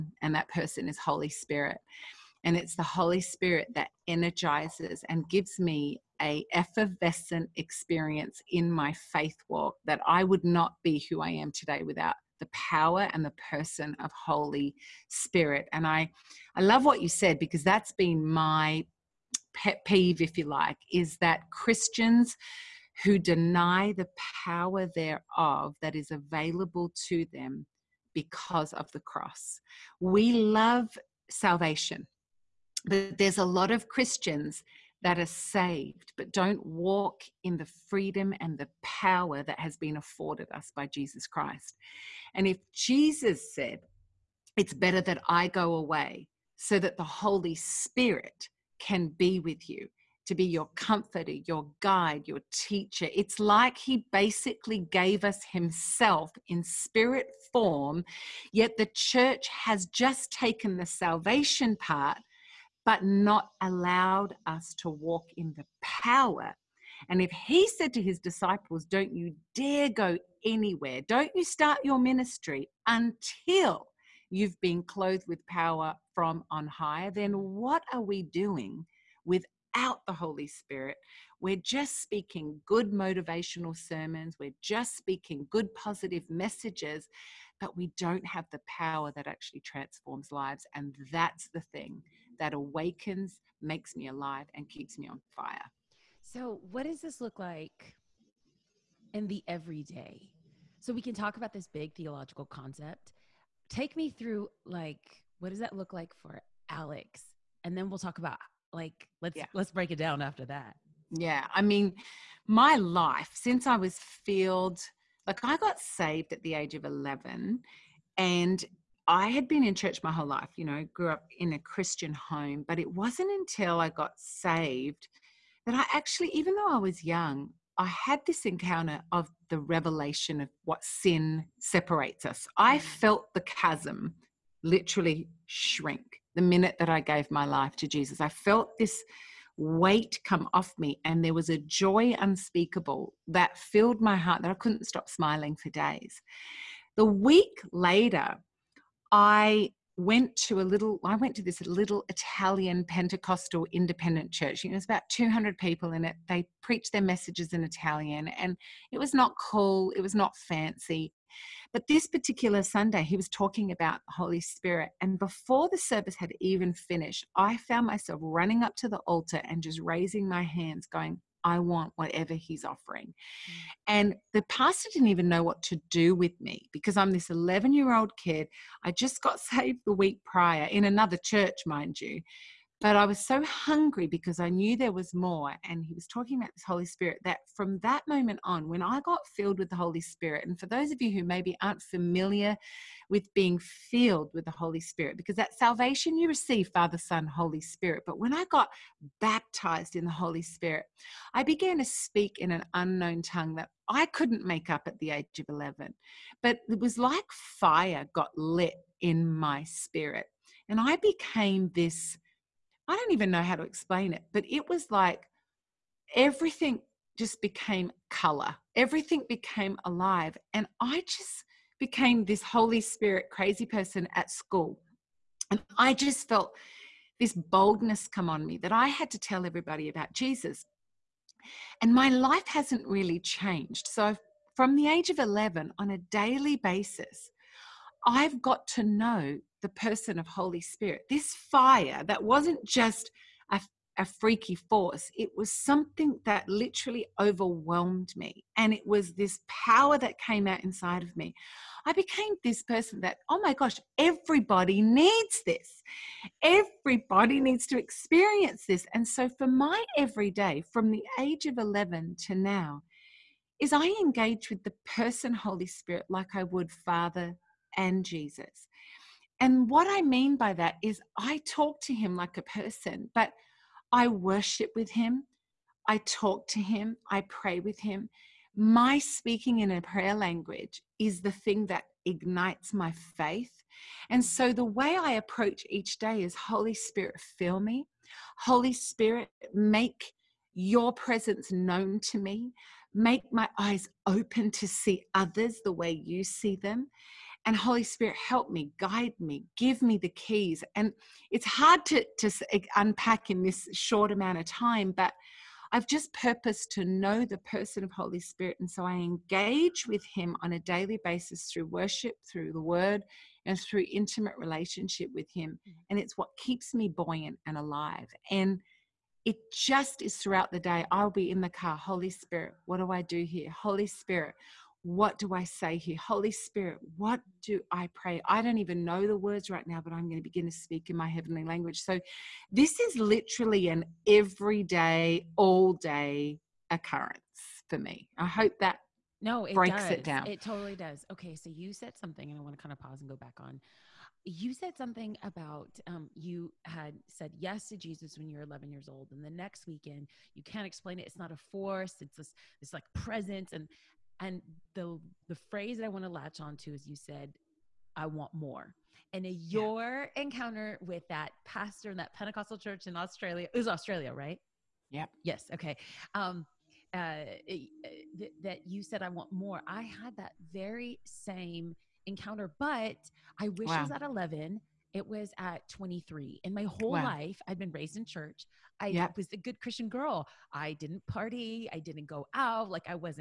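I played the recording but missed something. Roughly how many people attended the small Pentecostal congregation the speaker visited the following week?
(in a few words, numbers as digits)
200.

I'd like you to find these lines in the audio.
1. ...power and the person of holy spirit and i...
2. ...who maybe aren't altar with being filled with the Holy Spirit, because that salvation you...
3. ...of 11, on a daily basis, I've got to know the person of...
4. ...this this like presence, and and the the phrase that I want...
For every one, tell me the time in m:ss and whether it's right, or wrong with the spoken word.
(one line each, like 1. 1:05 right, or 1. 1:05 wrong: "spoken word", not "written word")
1. 0:12 right
2. 3:11 wrong: "familiar", not "altar"
3. 3:55 right
4. 5:52 right.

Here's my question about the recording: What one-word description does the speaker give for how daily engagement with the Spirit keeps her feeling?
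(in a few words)
buoyant.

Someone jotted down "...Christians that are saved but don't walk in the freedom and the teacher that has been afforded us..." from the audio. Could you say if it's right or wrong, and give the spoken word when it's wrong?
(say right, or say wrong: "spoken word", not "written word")
wrong: "power", not "teacher".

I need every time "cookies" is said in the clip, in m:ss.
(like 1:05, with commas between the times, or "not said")
not said.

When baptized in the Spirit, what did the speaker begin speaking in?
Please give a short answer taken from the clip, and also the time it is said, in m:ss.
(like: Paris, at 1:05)
an unknown tongue, at 3:22.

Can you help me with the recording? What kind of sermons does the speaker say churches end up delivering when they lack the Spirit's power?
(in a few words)
motivational sermons.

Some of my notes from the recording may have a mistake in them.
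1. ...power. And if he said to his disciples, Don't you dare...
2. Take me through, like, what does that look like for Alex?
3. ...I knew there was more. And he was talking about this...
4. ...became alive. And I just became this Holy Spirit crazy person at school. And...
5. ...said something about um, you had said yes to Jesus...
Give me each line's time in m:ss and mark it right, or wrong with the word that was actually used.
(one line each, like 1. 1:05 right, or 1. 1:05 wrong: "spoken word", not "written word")
1. 1:05 right
2. 1:43 right
3. 3:04 right
4. 3:39 right
5. 5:44 right.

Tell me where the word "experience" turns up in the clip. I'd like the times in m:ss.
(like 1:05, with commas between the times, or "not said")
0:07, 4:17.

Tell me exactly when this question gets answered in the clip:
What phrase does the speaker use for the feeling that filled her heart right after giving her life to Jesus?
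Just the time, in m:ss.
2:21.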